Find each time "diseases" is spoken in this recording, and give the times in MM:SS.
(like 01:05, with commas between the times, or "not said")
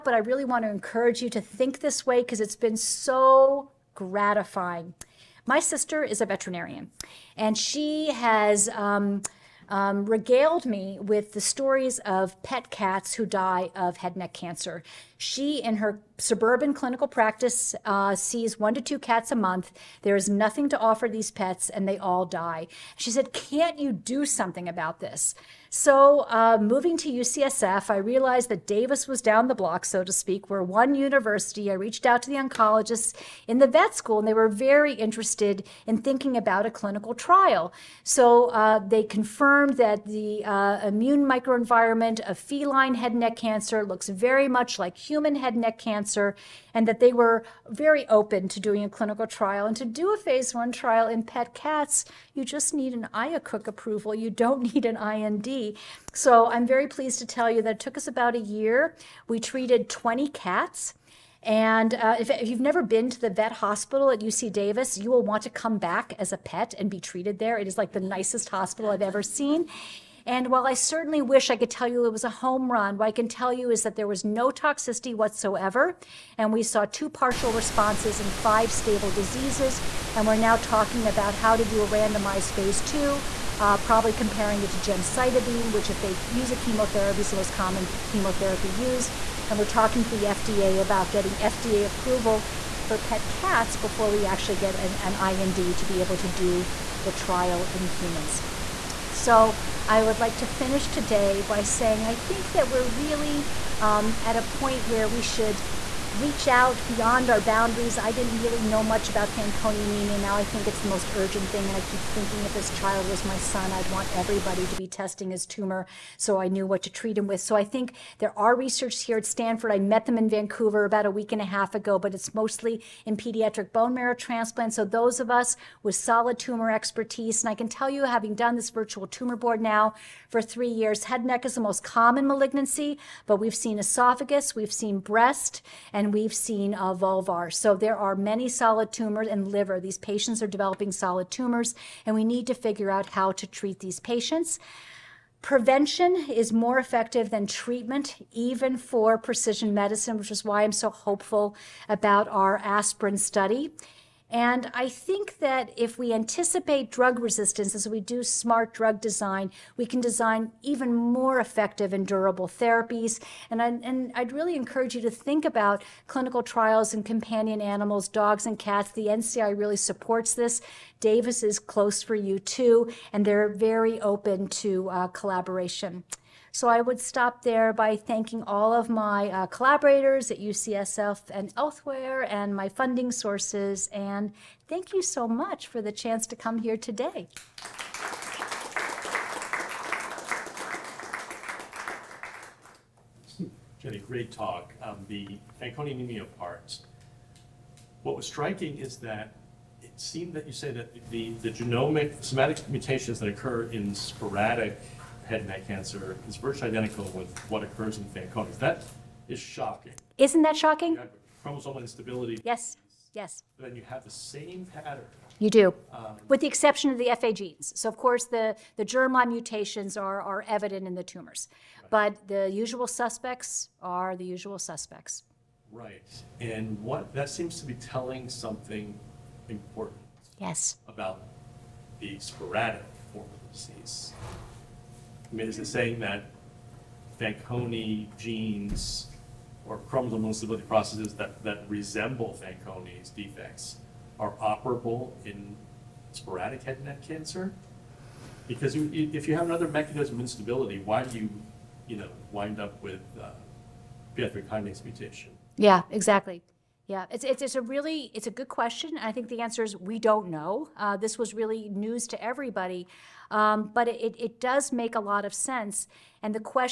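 01:19, 03:53.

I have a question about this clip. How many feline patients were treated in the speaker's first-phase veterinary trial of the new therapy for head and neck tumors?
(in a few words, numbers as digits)
20.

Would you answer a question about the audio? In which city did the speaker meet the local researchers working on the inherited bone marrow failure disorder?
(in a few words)
Vancouver.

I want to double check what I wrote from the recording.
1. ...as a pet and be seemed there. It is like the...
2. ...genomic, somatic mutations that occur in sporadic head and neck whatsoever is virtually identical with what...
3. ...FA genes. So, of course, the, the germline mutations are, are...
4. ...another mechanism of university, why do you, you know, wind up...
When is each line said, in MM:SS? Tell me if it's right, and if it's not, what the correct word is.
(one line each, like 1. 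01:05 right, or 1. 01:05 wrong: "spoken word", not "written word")
1. 01:06 wrong: "treated", not "seemed"
2. 03:21 wrong: "cancer", not "whatsoever"
3. 03:37 right
4. 04:09 wrong: "instability", not "university".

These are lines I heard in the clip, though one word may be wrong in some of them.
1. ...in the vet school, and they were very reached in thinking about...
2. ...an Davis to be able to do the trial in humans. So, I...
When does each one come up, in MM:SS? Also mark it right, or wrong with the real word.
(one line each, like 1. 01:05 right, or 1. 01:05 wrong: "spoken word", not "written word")
1. 00:33 wrong: "interested", not "reached"
2. 01:34 wrong: "IND", not "Davis".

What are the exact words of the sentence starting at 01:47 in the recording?
I didn't really know much about Fanconi anemia.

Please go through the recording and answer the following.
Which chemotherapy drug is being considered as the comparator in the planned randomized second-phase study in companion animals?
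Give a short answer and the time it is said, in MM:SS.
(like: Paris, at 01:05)
gemcitabine, at 01:24.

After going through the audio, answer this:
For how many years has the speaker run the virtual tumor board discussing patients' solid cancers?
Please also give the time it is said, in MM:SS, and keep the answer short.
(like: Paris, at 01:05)
3, at 02:10.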